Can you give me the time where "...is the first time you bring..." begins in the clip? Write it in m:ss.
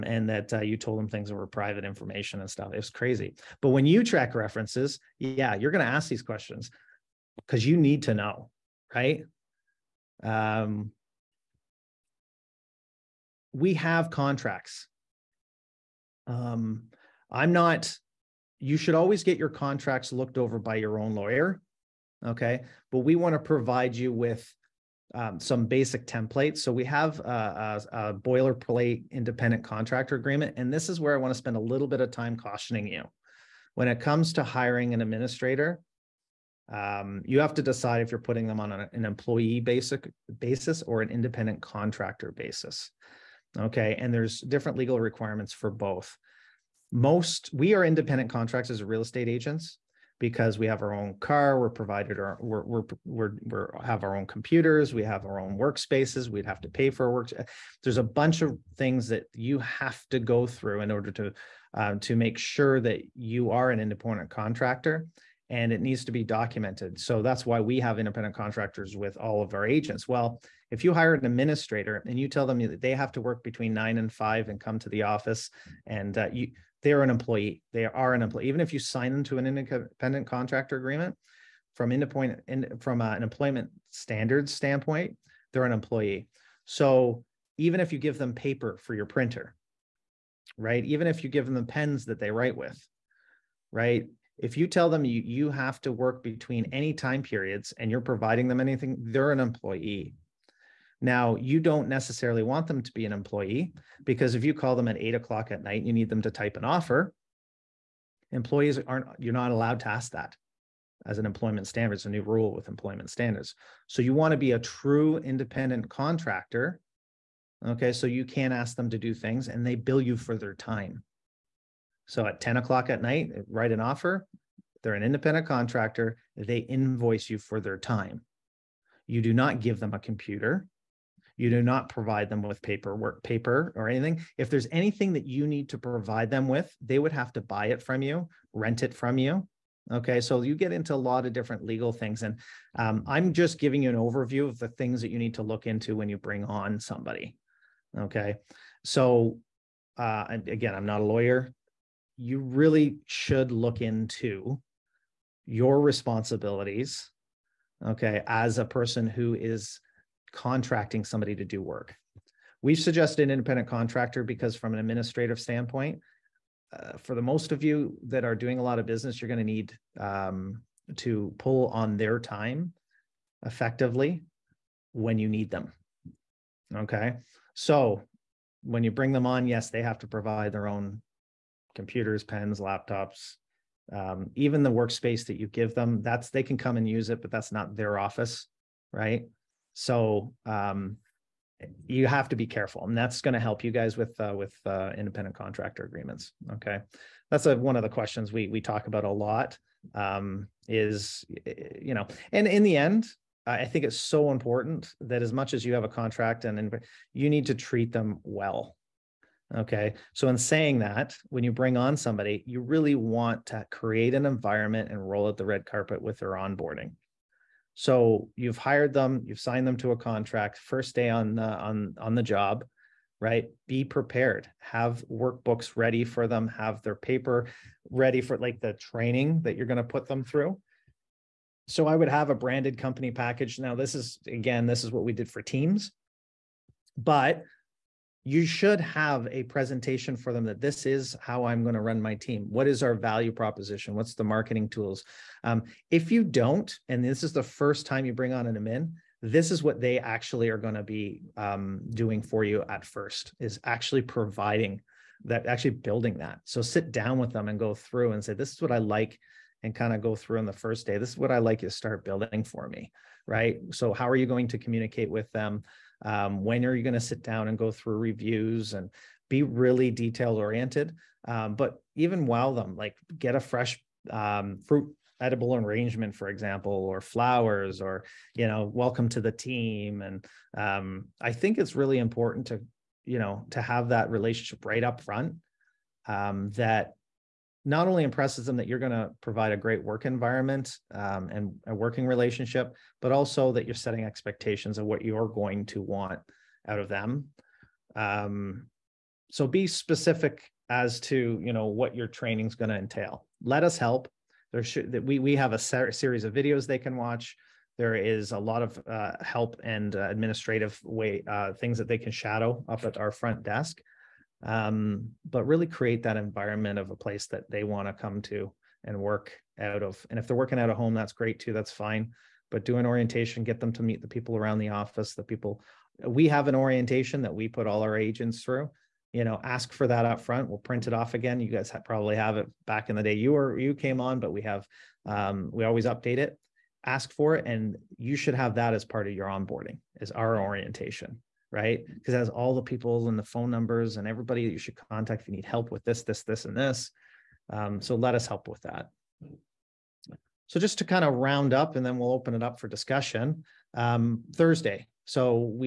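4:07.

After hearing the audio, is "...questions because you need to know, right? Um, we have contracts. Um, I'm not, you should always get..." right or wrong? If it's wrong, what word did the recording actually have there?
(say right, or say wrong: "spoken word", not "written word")
right.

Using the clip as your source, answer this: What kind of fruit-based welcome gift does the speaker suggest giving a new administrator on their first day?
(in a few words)
edible arrangement.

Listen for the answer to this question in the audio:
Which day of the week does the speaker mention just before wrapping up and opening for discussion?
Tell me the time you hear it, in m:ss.
5:54.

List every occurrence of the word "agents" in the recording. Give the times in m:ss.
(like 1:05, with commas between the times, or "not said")
0:49, 1:09, 5:27.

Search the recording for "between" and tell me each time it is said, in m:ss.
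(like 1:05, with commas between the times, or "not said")
1:13, 1:36.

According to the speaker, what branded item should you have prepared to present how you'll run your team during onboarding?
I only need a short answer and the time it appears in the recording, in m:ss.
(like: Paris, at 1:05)
company package, at 3:52.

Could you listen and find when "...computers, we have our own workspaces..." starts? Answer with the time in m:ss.
0:54.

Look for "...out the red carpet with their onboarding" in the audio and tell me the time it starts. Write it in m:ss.
3:35.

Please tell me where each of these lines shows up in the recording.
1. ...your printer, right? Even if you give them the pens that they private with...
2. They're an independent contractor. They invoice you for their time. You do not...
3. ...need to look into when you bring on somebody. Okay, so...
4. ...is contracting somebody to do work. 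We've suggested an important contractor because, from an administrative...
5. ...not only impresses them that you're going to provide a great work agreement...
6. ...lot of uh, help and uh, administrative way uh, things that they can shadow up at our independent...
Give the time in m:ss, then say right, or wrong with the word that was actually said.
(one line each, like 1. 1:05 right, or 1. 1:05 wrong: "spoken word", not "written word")
1. 1:28 wrong: "write", not "private"
2. 2:04 right
3. 2:25 right
4. 2:39 wrong: "independent", not "important"
5. 4:47 wrong: "environment", not "agreement"
6. 5:08 wrong: "front", not "independent".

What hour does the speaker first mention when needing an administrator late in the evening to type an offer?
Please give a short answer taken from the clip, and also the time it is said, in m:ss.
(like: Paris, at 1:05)
8 o'clock, at 1:44.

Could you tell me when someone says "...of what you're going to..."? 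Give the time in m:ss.
4:54.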